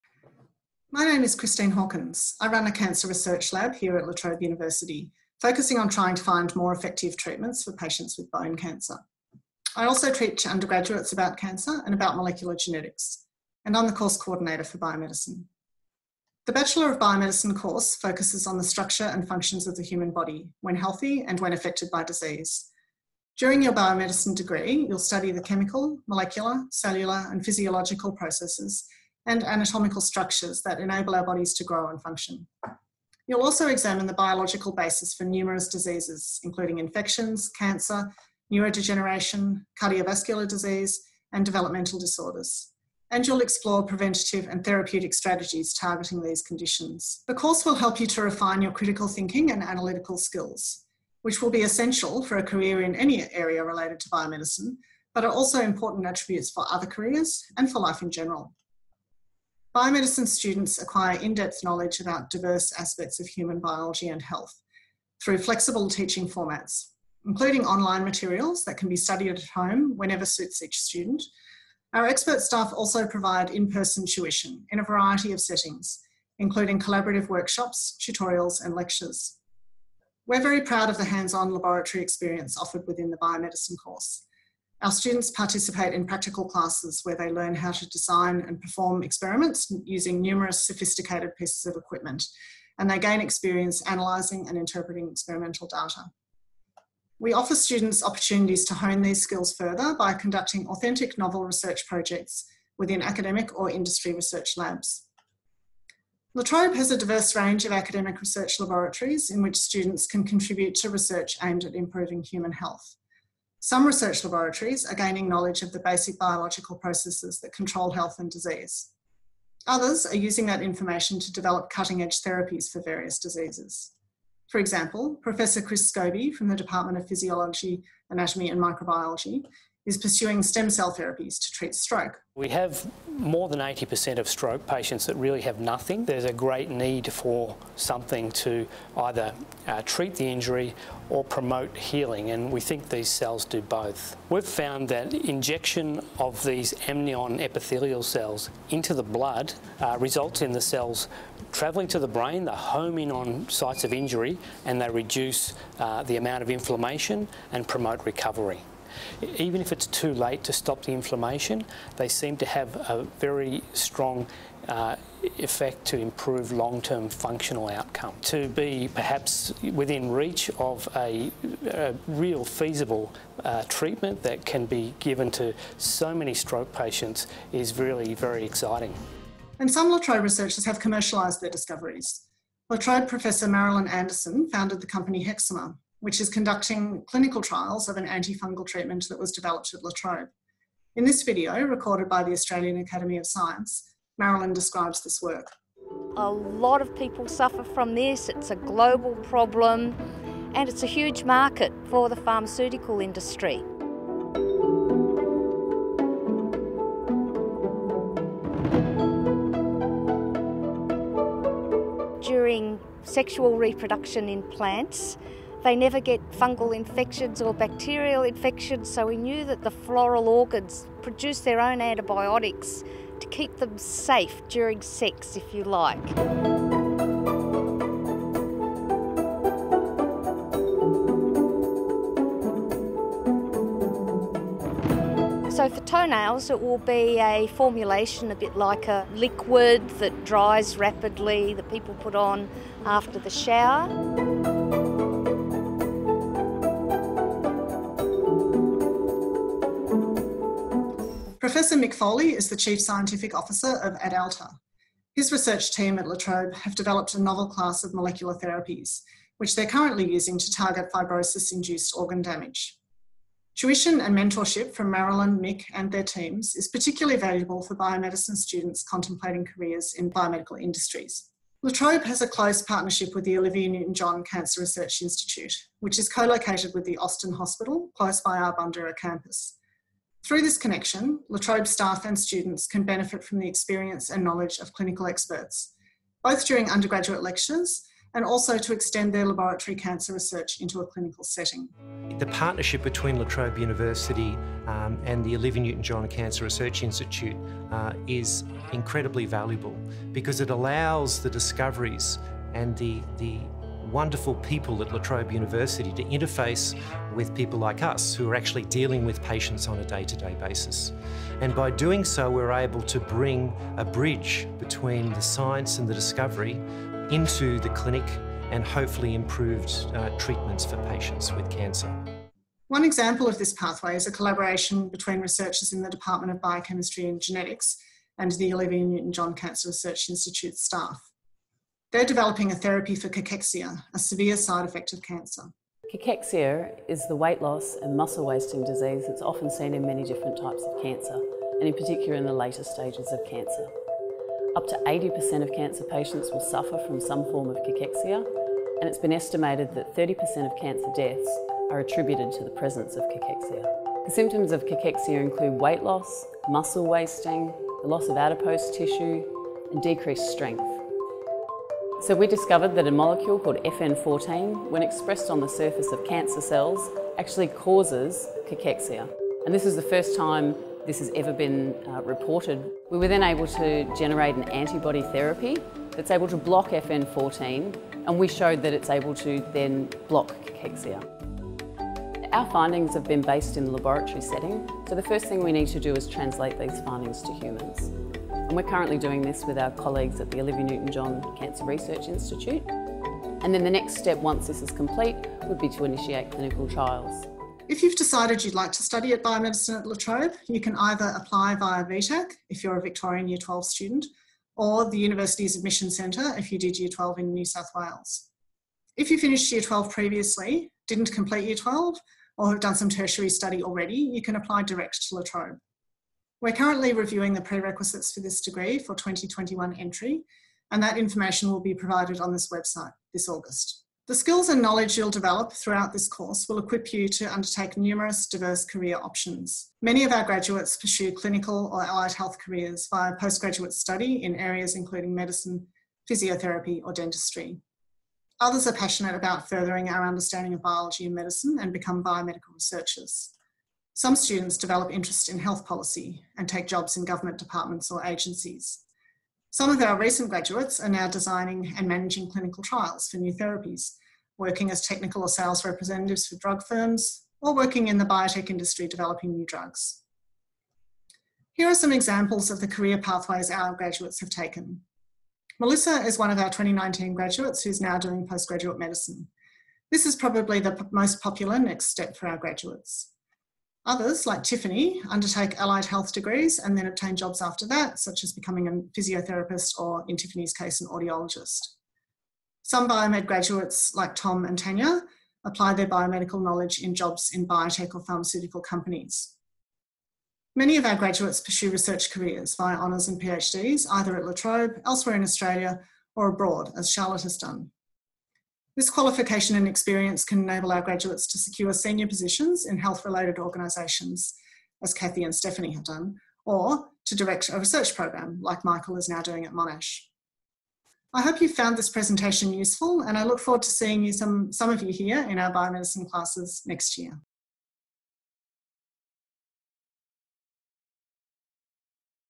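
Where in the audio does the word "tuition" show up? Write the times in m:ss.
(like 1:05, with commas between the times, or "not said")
1:14, 4:23.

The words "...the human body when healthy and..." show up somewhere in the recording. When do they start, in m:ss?
0:19.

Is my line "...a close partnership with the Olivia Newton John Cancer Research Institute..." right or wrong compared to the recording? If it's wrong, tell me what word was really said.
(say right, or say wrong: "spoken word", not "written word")
right.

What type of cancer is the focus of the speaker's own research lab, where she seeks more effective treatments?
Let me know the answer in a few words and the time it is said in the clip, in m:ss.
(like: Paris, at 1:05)
bone cancer, at 0:08.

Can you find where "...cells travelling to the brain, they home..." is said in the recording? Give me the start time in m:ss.
2:30.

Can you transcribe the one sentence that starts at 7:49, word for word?
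This is probably the most popular next step for our graduates.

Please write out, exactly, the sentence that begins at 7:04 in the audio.
The skills and knowledge you'll develop throughout this course will equip you to undertake numerous diverse career options.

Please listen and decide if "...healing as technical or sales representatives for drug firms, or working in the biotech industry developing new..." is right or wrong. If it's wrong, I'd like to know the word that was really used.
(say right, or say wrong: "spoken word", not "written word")
wrong: "working", not "healing".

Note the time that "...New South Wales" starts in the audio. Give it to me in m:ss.
6:47.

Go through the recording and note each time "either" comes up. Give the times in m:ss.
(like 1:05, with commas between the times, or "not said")
2:18, 6:40, 8:13.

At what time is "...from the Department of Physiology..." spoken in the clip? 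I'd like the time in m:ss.
2:06.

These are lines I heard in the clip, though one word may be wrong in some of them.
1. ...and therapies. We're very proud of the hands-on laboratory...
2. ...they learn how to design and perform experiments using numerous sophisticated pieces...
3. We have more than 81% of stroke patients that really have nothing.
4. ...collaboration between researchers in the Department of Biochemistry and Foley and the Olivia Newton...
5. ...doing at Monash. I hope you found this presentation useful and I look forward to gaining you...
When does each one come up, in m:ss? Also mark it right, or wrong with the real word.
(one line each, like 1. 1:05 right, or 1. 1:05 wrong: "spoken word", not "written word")
1. 1:18 wrong: "lectures", not "therapies"
2. 1:27 right
3. 2:12 wrong: "80", not "81"
4. 5:24 wrong: "Genetics", not "Foley"
5. 8:29 wrong: "seeing", not "gaining".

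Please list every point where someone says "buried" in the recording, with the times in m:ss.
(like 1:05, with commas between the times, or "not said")
not said.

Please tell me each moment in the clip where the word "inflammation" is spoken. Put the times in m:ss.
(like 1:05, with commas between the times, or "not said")
2:36, 2:40.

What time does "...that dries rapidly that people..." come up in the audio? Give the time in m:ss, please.
3:59.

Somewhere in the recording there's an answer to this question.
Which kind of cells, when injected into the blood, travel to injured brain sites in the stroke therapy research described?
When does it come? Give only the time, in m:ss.
2:26.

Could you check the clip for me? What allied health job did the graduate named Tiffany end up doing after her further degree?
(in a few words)
audiologist.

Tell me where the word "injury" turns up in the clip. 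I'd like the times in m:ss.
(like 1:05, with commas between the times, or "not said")
2:20, 2:33.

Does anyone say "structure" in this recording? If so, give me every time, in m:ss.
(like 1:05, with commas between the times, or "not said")
0:18, 0:30.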